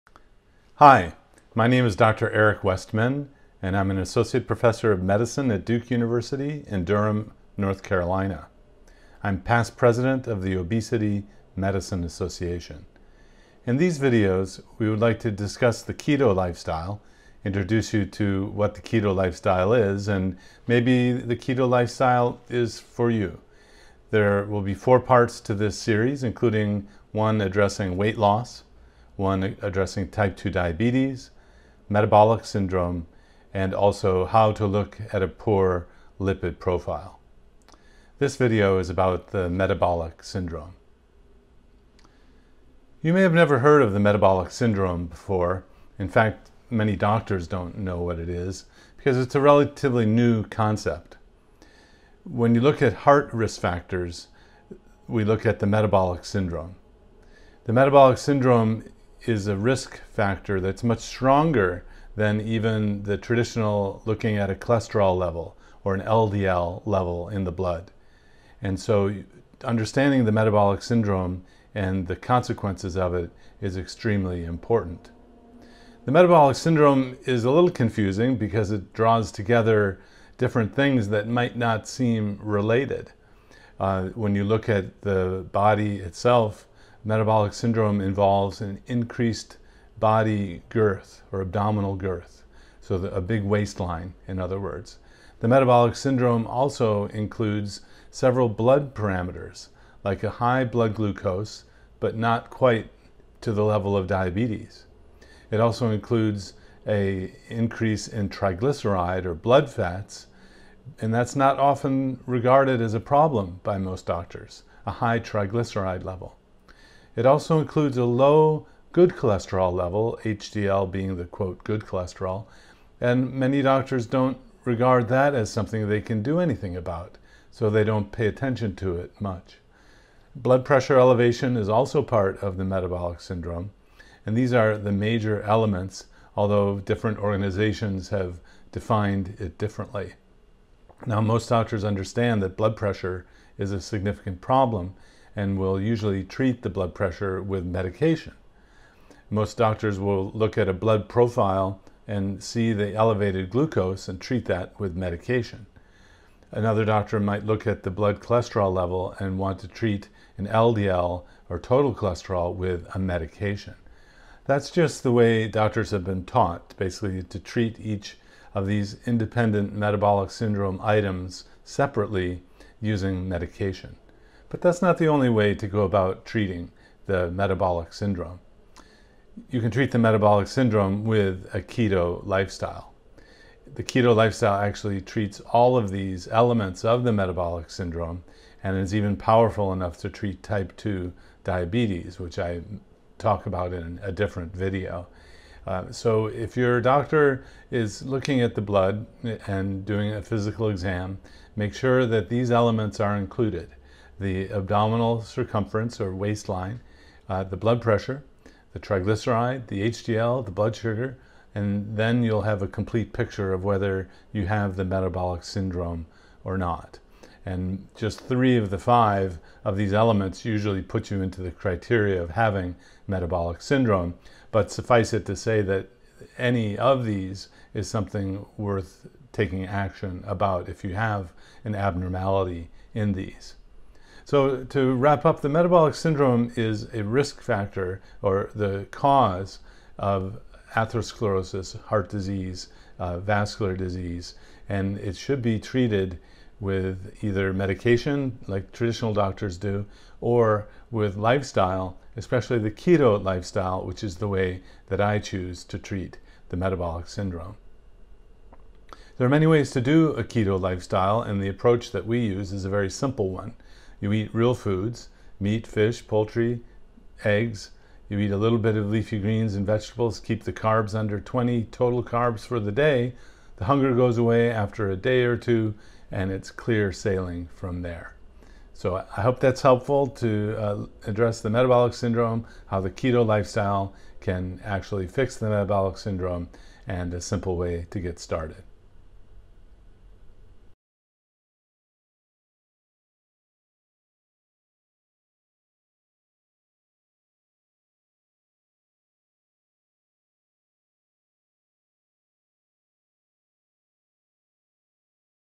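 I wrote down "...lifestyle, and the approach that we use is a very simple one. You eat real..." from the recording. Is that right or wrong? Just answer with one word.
right.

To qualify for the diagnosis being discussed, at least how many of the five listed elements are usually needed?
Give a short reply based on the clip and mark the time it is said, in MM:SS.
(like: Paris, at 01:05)
3, at 03:38.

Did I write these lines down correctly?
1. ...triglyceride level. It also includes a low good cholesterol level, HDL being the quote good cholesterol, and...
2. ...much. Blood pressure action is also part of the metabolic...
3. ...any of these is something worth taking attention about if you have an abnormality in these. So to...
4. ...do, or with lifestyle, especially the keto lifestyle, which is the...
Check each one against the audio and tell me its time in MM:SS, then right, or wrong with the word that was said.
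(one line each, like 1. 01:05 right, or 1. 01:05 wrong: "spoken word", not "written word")
1. 01:55 right
2. 02:09 wrong: "elevation", not "action"
3. 03:46 wrong: "action", not "attention"
4. 04:09 right.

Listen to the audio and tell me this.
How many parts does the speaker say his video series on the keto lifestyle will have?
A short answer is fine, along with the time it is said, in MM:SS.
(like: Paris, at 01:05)
4, at 00:24.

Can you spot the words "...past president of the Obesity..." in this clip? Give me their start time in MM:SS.
00:09.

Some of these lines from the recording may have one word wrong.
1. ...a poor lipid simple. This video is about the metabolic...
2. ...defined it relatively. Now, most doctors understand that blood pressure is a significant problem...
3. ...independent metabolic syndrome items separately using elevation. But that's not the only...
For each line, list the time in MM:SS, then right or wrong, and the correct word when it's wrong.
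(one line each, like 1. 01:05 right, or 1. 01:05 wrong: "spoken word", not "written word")
1. 00:35 wrong: "profile", not "simple"
2. 02:18 wrong: "differently", not "relatively"
3. 02:49 wrong: "medication", not "elevation".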